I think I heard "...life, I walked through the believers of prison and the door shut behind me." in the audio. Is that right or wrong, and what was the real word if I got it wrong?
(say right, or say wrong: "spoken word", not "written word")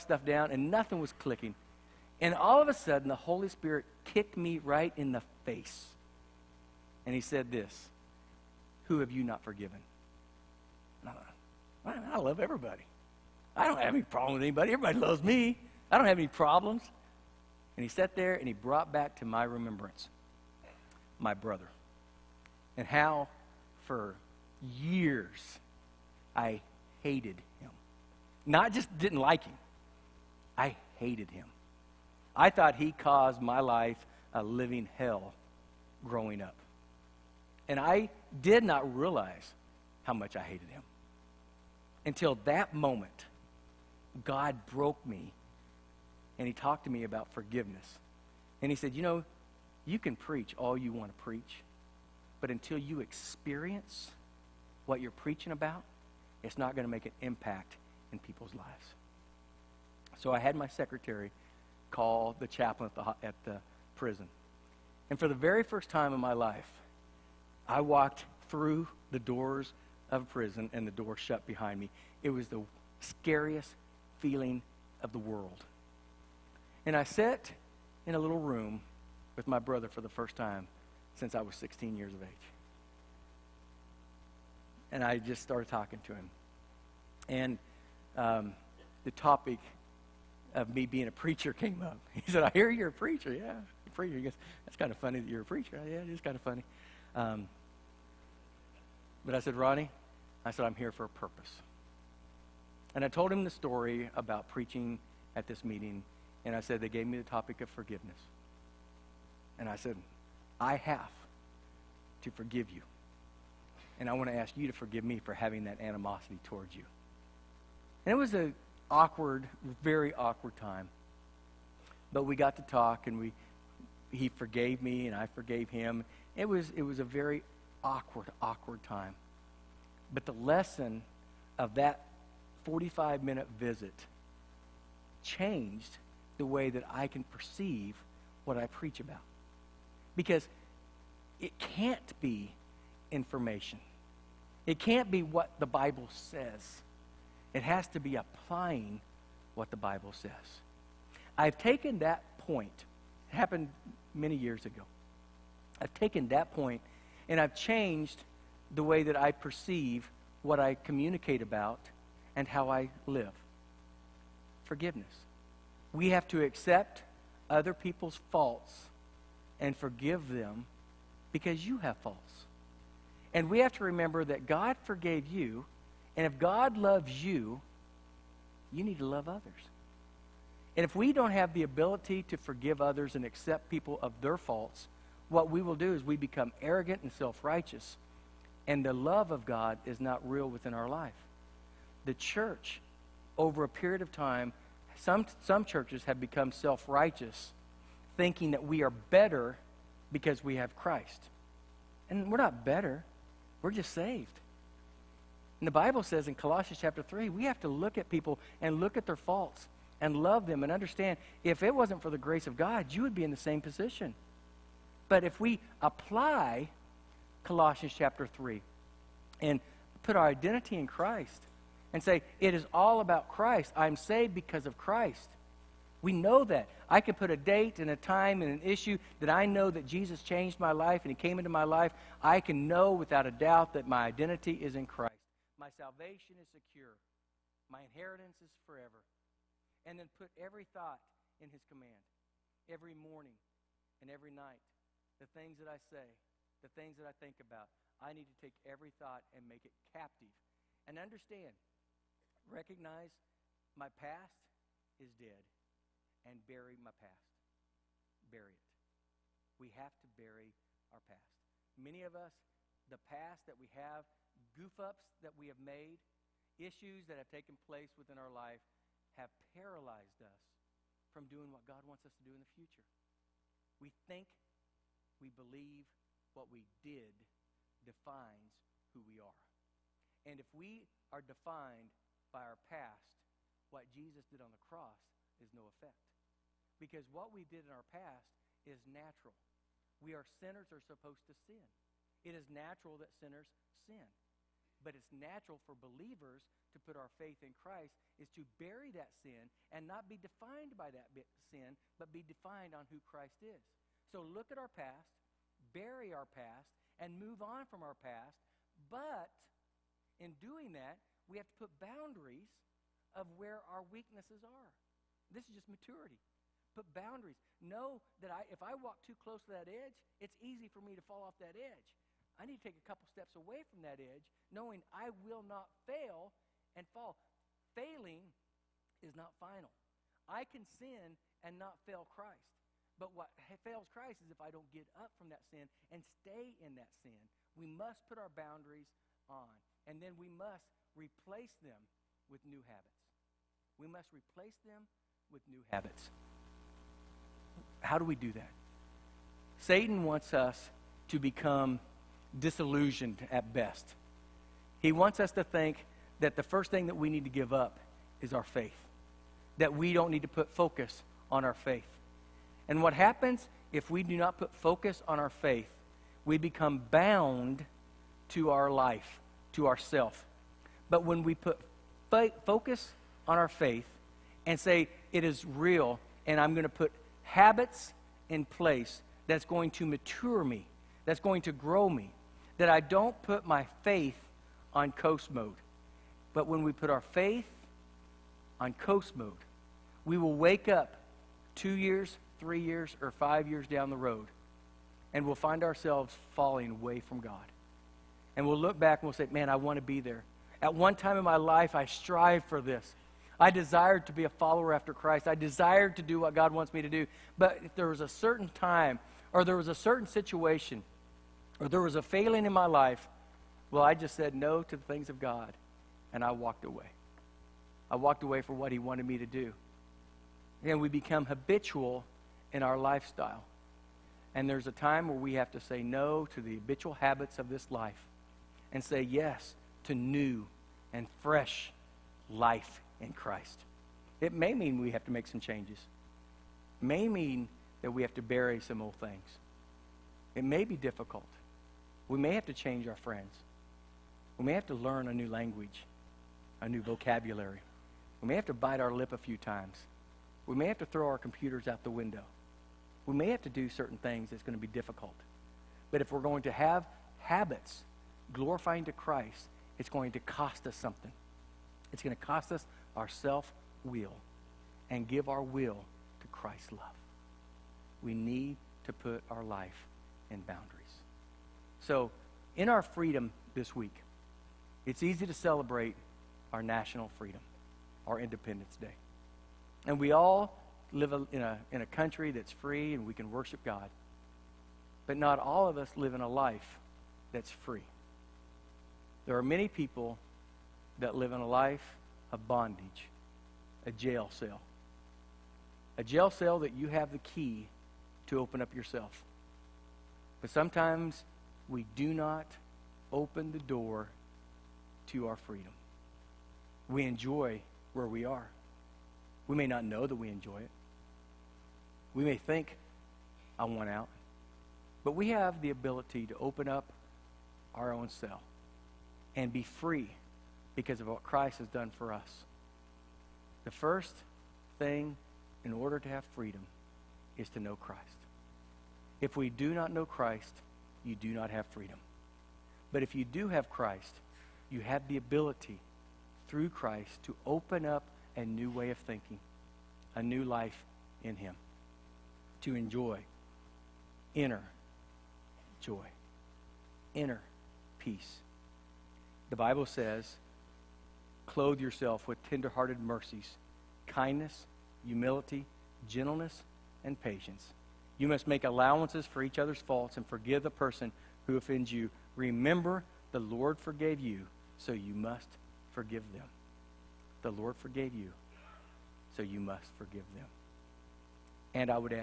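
wrong: "doors", not "believers".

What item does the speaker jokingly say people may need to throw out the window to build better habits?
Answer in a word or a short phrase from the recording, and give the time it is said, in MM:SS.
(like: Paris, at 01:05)
Computers, at 07:31.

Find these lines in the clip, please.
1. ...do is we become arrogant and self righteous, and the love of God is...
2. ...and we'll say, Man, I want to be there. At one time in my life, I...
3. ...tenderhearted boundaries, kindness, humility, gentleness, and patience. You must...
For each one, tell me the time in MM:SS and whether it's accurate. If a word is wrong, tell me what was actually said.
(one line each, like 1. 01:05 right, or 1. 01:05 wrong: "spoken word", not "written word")
1. 03:05 right
2. 06:39 right
3. 09:12 wrong: "mercies", not "boundaries".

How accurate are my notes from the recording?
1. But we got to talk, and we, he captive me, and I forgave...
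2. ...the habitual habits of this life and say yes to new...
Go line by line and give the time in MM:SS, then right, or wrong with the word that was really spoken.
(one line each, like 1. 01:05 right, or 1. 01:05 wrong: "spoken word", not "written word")
1. 02:02 wrong: "forgave", not "captive"
2. 07:06 right.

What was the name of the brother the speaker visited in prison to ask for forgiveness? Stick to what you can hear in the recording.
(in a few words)
Ronnie.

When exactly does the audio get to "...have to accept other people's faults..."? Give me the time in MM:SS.
02:46.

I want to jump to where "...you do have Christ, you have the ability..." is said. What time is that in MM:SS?
08:53.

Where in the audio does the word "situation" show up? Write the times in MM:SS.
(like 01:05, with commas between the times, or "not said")
06:50.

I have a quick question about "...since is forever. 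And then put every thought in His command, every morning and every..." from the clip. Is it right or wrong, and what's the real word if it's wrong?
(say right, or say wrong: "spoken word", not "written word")
wrong: "inheritance", not "since".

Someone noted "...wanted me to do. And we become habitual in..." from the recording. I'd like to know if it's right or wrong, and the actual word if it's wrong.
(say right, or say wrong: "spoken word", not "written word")
right.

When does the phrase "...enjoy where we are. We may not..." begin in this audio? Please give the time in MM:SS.
08:27.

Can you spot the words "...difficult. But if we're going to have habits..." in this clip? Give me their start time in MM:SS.
07:34.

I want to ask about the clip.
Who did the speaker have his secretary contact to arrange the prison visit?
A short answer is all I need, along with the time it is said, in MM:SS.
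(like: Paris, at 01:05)
The chaplain, at 01:02.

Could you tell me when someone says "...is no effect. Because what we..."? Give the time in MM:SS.
04:45.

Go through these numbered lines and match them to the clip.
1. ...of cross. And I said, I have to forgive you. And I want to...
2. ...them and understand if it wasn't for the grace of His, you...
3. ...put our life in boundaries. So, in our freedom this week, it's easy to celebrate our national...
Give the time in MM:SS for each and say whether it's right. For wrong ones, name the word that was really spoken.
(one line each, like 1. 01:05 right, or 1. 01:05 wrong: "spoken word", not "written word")
1. 01:47 wrong: "forgiveness", not "cross"
2. 03:30 wrong: "God", not "His"
3. 07:48 right.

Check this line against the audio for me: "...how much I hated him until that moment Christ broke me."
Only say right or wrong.
wrong.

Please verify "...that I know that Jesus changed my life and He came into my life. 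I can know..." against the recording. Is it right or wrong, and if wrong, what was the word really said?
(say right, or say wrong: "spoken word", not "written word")
right.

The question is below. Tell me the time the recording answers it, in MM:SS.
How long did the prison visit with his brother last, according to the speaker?
02:12.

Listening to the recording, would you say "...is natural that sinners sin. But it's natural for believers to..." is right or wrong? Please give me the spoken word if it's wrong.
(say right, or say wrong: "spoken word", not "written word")
right.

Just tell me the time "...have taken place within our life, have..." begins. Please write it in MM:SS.
04:27.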